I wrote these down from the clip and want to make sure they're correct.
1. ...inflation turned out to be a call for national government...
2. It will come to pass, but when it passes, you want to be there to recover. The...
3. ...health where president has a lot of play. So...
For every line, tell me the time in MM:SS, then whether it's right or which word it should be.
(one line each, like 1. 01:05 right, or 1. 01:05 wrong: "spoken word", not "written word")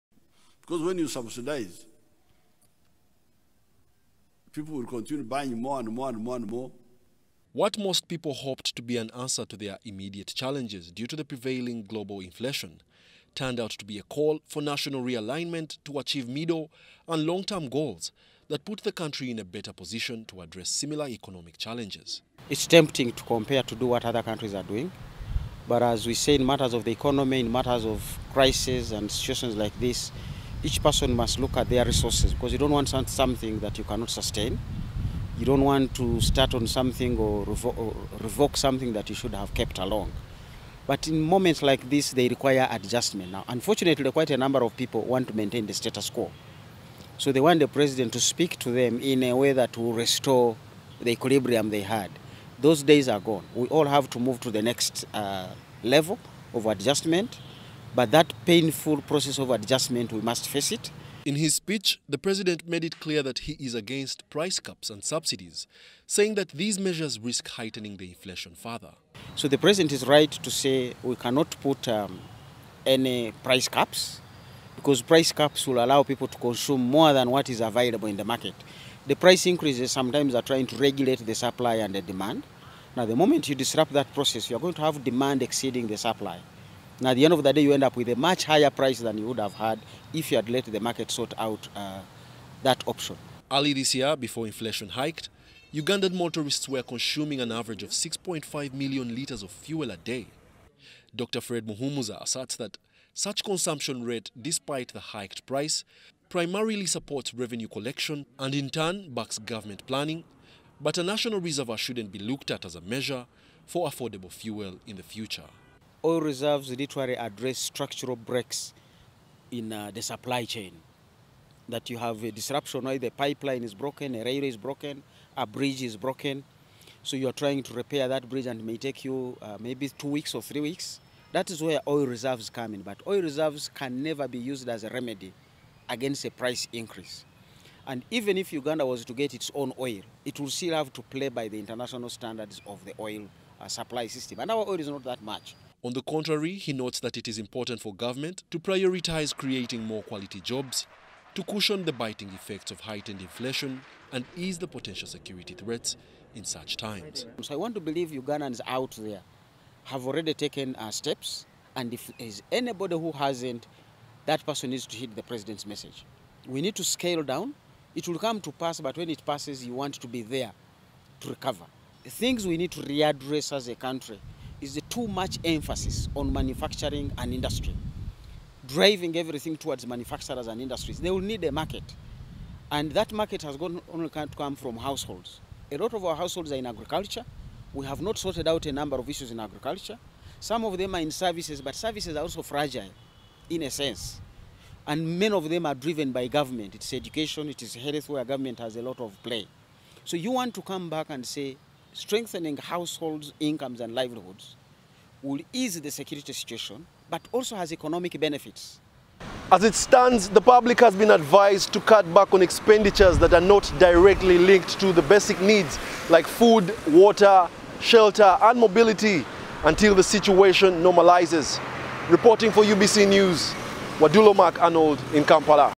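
1. 00:12 wrong: "realignment", not "government"
2. 02:47 right
3. 03:17 wrong: "government", not "president".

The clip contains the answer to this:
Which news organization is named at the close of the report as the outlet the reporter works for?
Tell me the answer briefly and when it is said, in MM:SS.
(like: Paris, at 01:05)
UBC News, at 03:42.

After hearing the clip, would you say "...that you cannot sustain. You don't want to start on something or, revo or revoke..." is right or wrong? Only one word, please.
right.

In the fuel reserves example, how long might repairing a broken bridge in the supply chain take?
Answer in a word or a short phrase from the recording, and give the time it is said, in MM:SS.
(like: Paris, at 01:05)
two weeks or three weeks, at 02:09.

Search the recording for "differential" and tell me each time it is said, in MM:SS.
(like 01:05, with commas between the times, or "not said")
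not said.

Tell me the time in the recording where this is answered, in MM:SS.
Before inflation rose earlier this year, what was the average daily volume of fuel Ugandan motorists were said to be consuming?
01:37.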